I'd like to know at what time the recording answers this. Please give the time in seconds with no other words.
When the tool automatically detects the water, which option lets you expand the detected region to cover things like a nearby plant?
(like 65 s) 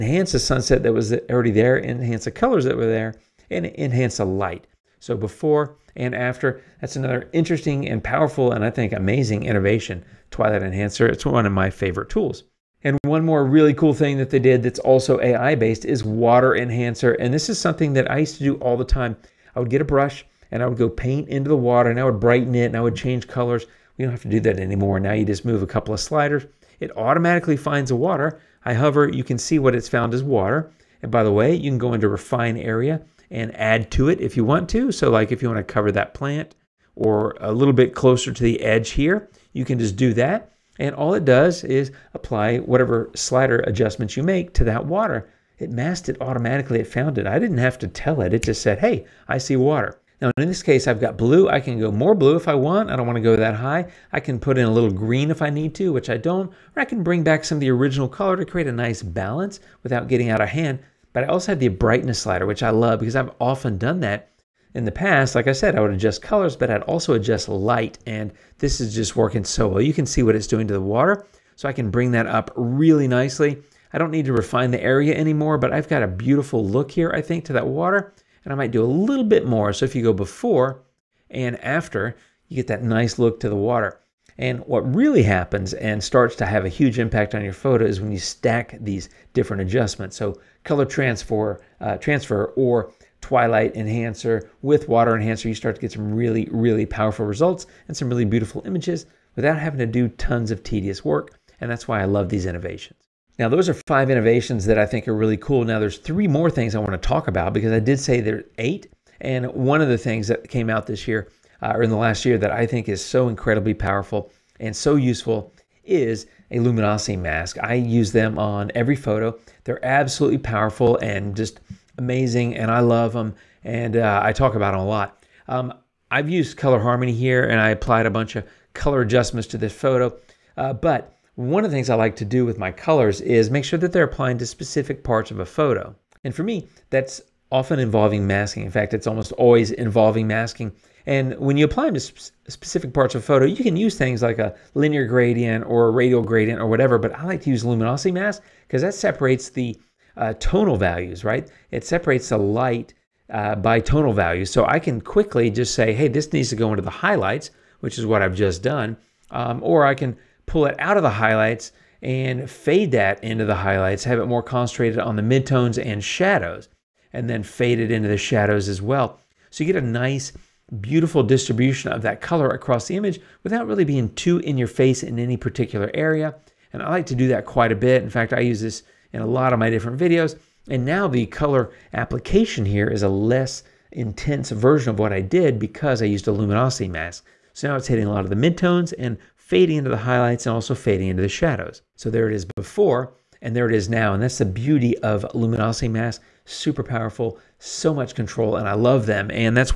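32 s.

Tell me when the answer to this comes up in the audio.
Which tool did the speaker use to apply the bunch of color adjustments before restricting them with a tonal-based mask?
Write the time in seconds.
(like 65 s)
126 s.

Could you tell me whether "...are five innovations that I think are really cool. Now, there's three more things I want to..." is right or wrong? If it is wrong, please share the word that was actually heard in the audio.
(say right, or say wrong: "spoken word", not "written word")
right.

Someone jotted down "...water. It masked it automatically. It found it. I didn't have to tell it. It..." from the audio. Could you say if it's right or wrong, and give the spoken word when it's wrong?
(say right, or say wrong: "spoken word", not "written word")
right.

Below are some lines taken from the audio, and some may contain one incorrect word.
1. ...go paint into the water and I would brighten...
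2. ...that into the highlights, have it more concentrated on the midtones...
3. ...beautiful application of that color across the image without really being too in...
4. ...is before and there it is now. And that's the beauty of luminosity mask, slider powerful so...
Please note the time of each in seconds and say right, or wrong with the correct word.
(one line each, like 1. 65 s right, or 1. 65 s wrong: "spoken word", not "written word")
1. 20 s right
2. 162 s right
3. 170 s wrong: "distribution", not "application"
4. 192 s wrong: "super", not "slider".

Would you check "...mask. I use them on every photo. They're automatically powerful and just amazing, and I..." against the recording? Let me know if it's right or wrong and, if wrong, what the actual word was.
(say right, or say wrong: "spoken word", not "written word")
wrong: "absolutely", not "automatically".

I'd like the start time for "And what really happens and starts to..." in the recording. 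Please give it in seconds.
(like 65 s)
84 s.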